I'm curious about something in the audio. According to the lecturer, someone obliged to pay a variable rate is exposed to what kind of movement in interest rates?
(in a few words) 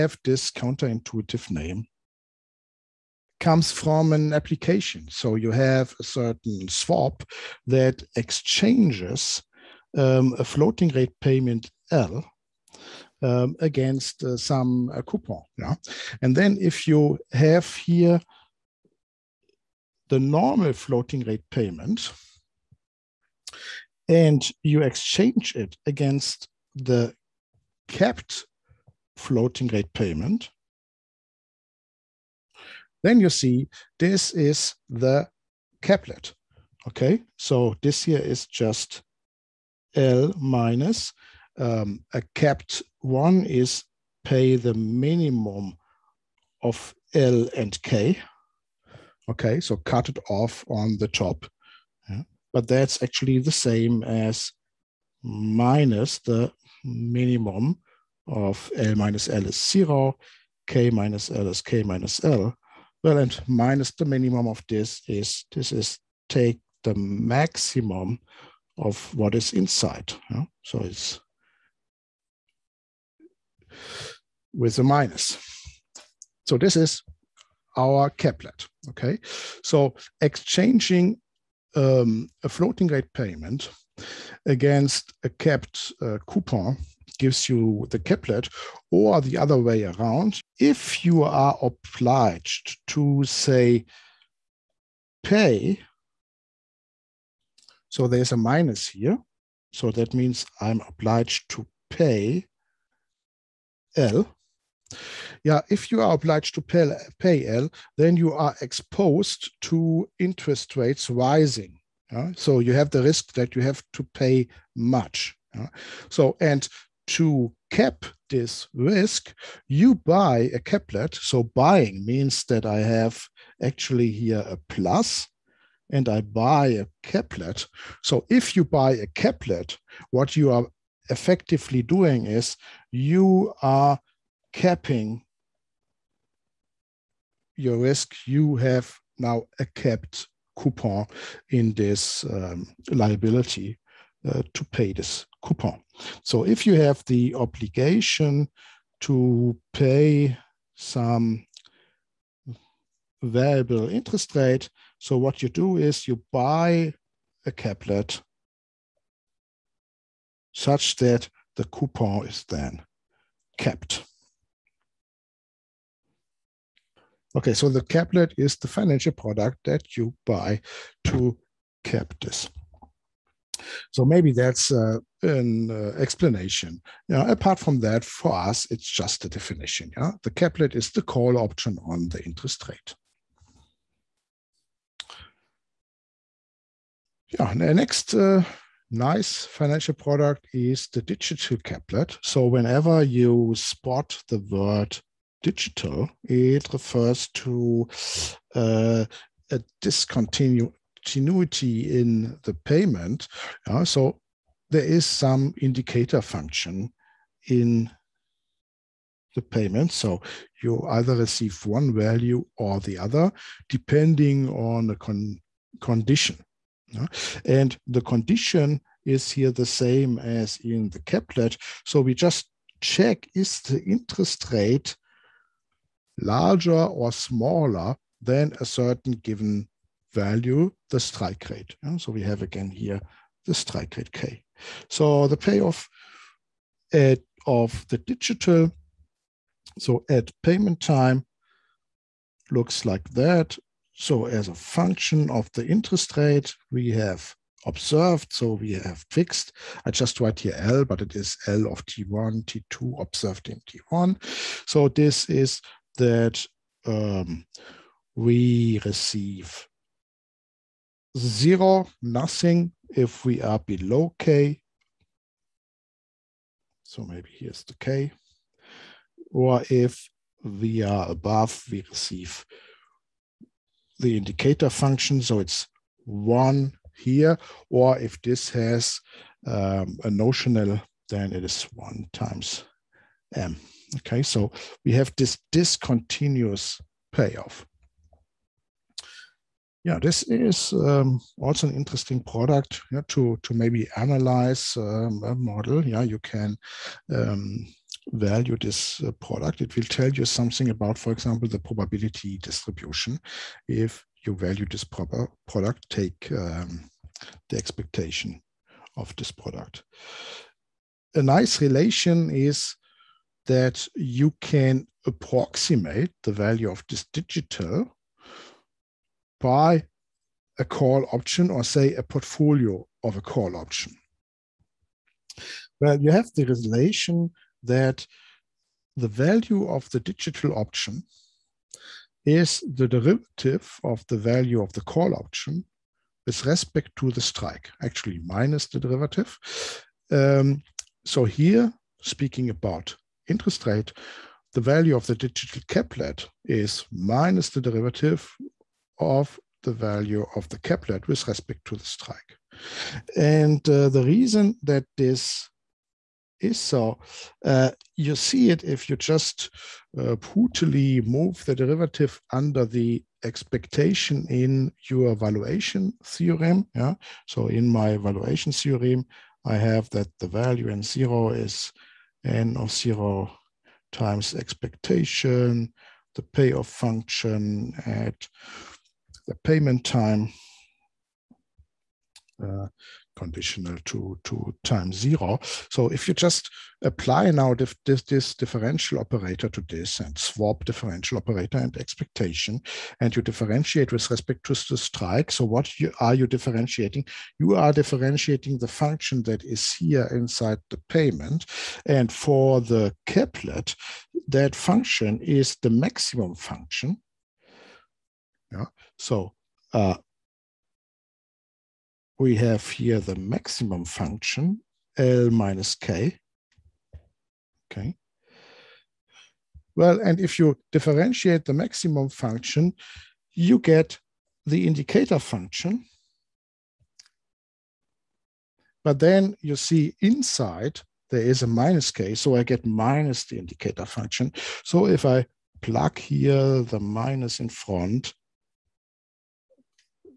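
interest rates rising.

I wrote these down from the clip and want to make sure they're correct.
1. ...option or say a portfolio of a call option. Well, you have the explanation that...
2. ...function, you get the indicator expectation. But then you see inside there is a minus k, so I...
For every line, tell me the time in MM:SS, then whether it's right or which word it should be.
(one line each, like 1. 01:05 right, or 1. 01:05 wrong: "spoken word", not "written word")
1. 05:21 wrong: "relation", not "explanation"
2. 07:02 wrong: "function", not "expectation".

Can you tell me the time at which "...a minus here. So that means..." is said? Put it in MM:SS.
01:38.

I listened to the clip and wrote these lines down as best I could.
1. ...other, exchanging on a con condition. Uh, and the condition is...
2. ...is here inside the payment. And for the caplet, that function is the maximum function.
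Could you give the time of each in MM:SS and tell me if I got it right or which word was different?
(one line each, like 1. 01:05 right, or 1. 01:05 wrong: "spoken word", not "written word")
1. 03:32 wrong: "depending", not "exchanging"
2. 06:39 right.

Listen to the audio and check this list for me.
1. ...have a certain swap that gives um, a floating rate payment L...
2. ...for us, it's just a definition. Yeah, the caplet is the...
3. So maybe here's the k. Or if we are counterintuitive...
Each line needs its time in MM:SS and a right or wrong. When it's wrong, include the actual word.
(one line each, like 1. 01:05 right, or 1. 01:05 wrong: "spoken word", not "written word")
1. 00:05 wrong: "exchanges", not "gives"
2. 02:58 right
3. 04:26 wrong: "above", not "counterintuitive".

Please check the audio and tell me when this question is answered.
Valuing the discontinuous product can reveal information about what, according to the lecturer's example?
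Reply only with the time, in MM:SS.
05:01.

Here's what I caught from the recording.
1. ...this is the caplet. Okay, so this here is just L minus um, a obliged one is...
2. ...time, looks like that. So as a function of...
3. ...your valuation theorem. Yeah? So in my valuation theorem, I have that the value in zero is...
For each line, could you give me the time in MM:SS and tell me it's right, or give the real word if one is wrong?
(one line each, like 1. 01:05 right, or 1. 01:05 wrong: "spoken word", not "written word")
1. 00:33 wrong: "capped", not "obliged"
2. 04:00 right
3. 06:04 right.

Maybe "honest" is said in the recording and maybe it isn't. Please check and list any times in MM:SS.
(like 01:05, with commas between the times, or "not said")
not said.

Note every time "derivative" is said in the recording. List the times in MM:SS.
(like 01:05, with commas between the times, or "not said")
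05:32, 05:38, 05:47, 06:01.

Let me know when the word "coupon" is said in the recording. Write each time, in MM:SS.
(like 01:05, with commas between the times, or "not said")
00:15, 01:26, 02:20, 02:25, 02:41.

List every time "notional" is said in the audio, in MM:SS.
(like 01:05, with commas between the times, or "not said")
04:40.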